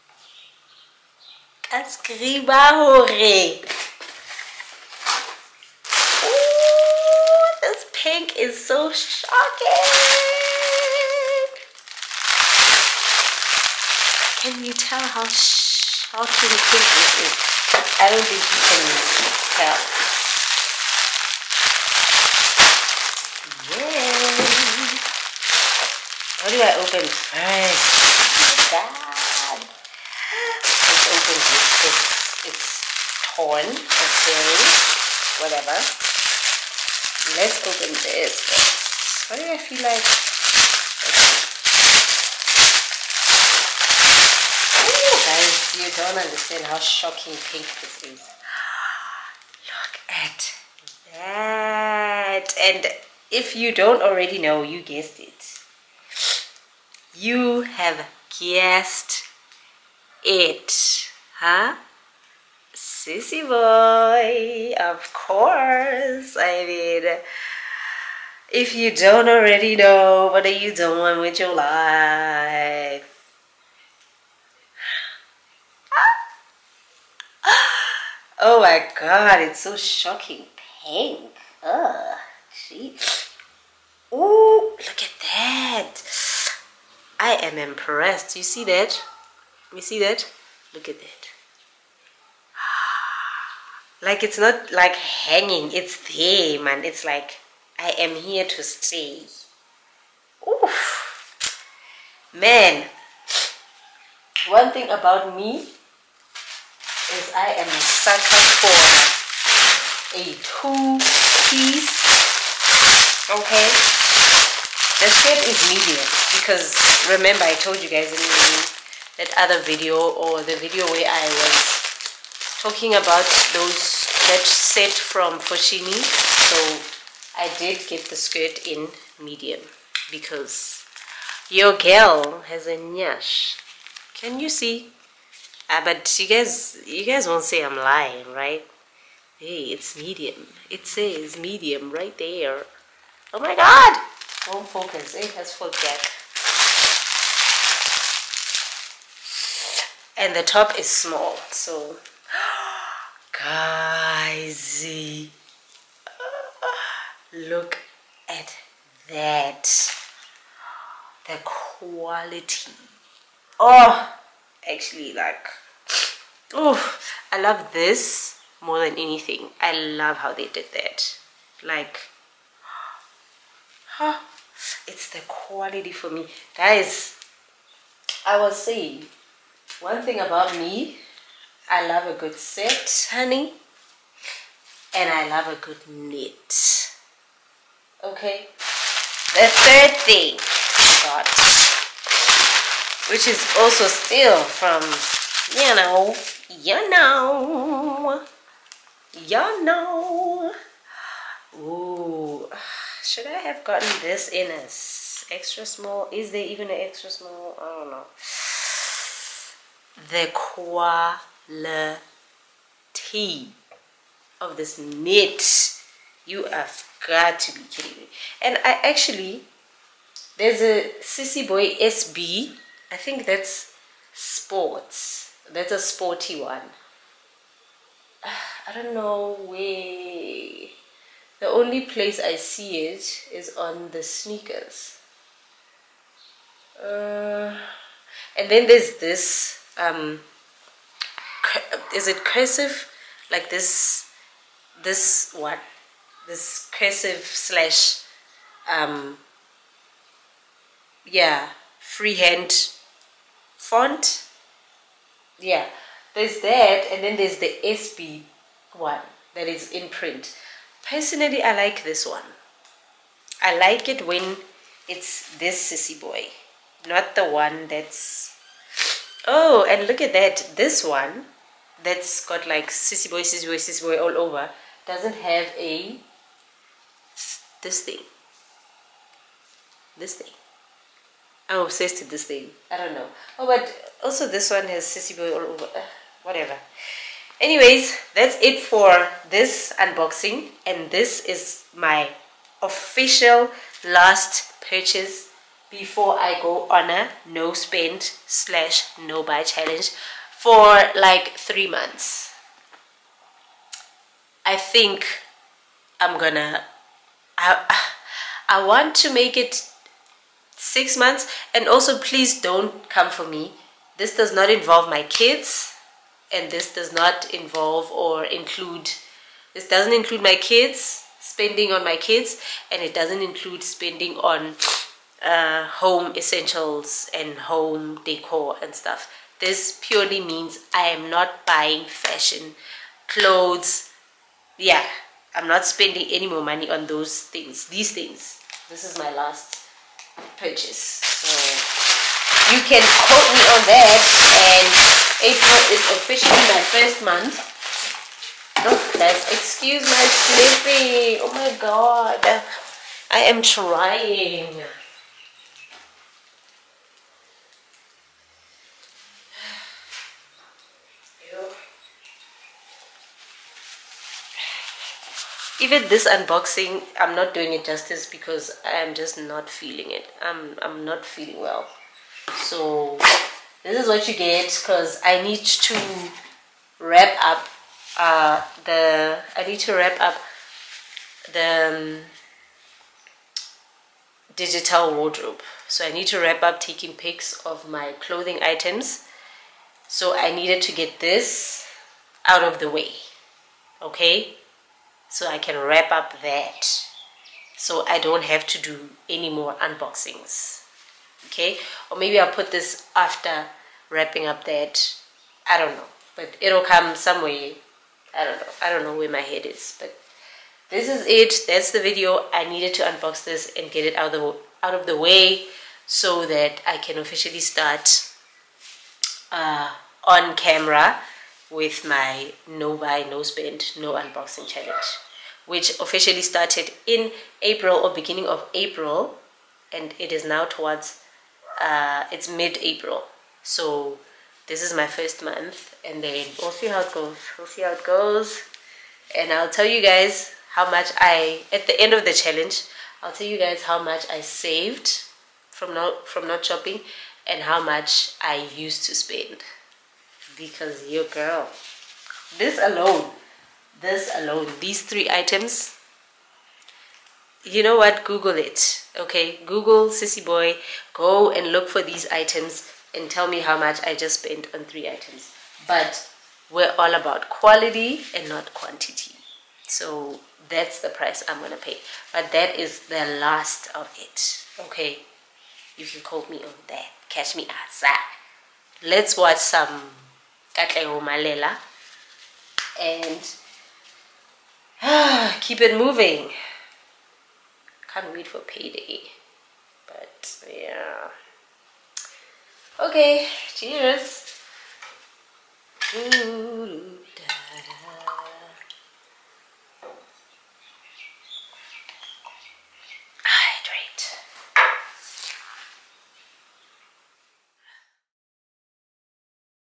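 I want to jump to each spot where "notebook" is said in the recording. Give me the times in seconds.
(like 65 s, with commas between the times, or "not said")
not said.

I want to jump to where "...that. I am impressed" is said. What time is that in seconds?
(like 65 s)
85 s.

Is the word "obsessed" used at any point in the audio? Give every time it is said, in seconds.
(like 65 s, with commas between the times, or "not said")
281 s.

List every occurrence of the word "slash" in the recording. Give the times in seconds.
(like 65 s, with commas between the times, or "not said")
247 s, 298 s.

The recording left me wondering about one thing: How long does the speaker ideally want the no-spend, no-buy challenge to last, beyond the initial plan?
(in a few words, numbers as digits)
6 months.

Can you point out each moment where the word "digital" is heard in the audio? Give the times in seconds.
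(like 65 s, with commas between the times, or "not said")
384 s.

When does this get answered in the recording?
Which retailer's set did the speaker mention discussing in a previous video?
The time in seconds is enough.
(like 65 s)
124 s.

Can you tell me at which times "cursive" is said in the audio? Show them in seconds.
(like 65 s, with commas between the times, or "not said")
242 s, 246 s.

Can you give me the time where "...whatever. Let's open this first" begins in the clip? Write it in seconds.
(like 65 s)
35 s.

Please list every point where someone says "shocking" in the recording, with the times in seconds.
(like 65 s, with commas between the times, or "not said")
8 s, 15 s, 46 s, 79 s.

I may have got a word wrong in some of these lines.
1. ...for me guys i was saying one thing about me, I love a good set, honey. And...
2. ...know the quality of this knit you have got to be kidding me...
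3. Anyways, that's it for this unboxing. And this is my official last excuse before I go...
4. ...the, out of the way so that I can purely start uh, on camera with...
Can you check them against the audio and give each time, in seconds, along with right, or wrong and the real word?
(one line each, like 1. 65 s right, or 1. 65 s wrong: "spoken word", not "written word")
1. 175 s right
2. 207 s right
3. 287 s wrong: "purchase", not "excuse"
4. 414 s wrong: "officially", not "purely".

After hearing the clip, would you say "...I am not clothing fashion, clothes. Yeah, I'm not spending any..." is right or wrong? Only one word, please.
wrong.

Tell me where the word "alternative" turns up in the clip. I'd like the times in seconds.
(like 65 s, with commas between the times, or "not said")
not said.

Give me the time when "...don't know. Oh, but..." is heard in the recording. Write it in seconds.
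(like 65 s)
282 s.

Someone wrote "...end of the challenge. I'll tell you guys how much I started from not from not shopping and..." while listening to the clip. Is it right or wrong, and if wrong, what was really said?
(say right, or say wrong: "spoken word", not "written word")
wrong: "saved", not "started".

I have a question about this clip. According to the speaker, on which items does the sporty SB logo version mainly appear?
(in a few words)
Sneakers.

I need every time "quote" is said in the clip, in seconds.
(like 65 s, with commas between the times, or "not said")
342 s, 476 s.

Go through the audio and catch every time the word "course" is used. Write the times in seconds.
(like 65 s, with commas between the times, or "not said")
65 s.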